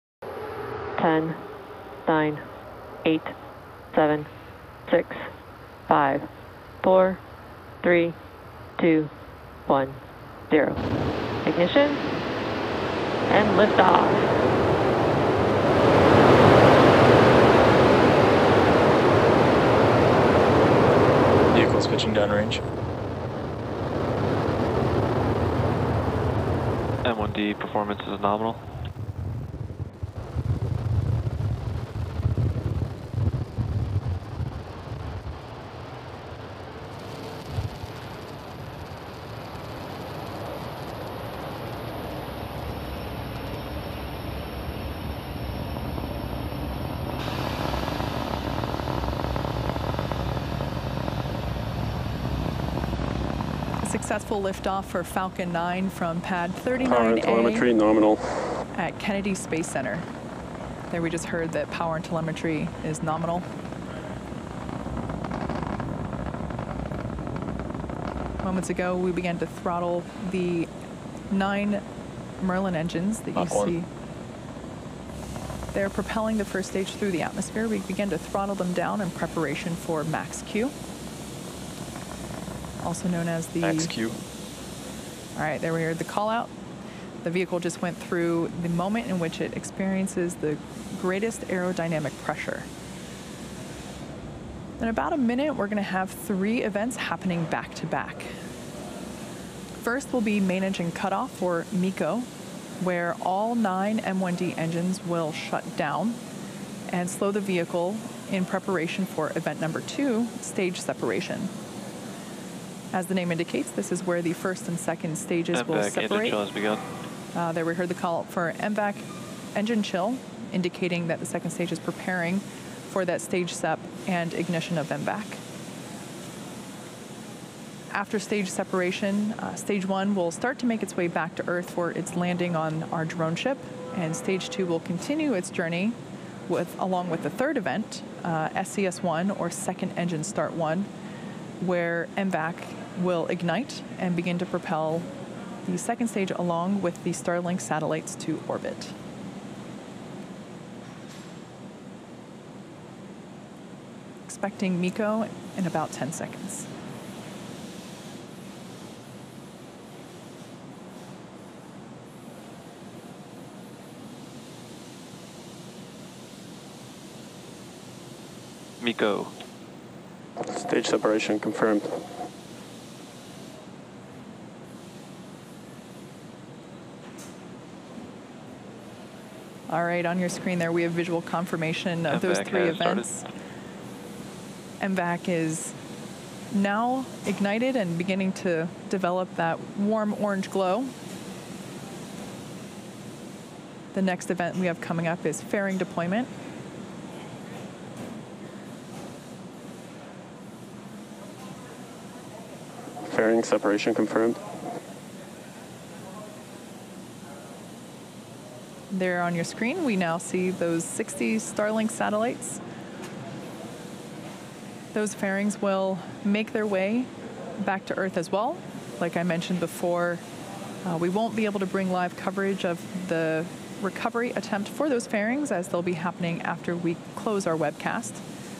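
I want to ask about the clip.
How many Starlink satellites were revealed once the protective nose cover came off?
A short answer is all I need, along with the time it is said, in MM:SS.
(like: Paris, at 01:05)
60, at 03:30.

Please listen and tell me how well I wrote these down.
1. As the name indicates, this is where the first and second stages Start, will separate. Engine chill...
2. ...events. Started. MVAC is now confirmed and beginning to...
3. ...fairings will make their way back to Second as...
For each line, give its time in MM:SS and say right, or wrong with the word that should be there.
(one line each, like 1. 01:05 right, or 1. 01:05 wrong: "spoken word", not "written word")
1. 01:52 wrong: "MVAC", not "Start"
2. 03:02 wrong: "ignited", not "confirmed"
3. 03:35 wrong: "Earth", not "Second".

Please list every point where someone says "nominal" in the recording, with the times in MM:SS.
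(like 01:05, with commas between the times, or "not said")
00:28, 00:57, 01:03.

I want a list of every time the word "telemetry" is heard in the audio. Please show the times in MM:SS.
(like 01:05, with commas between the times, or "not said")
00:57, 01:02.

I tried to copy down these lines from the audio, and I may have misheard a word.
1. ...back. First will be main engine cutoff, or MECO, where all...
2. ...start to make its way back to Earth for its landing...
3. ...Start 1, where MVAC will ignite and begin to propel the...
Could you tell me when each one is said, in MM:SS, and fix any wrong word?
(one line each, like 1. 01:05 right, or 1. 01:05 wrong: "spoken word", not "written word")
1. 01:37 right
2. 02:10 right
3. 02:20 right.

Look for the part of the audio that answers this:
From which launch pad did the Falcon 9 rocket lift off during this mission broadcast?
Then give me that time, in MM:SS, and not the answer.
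00:56.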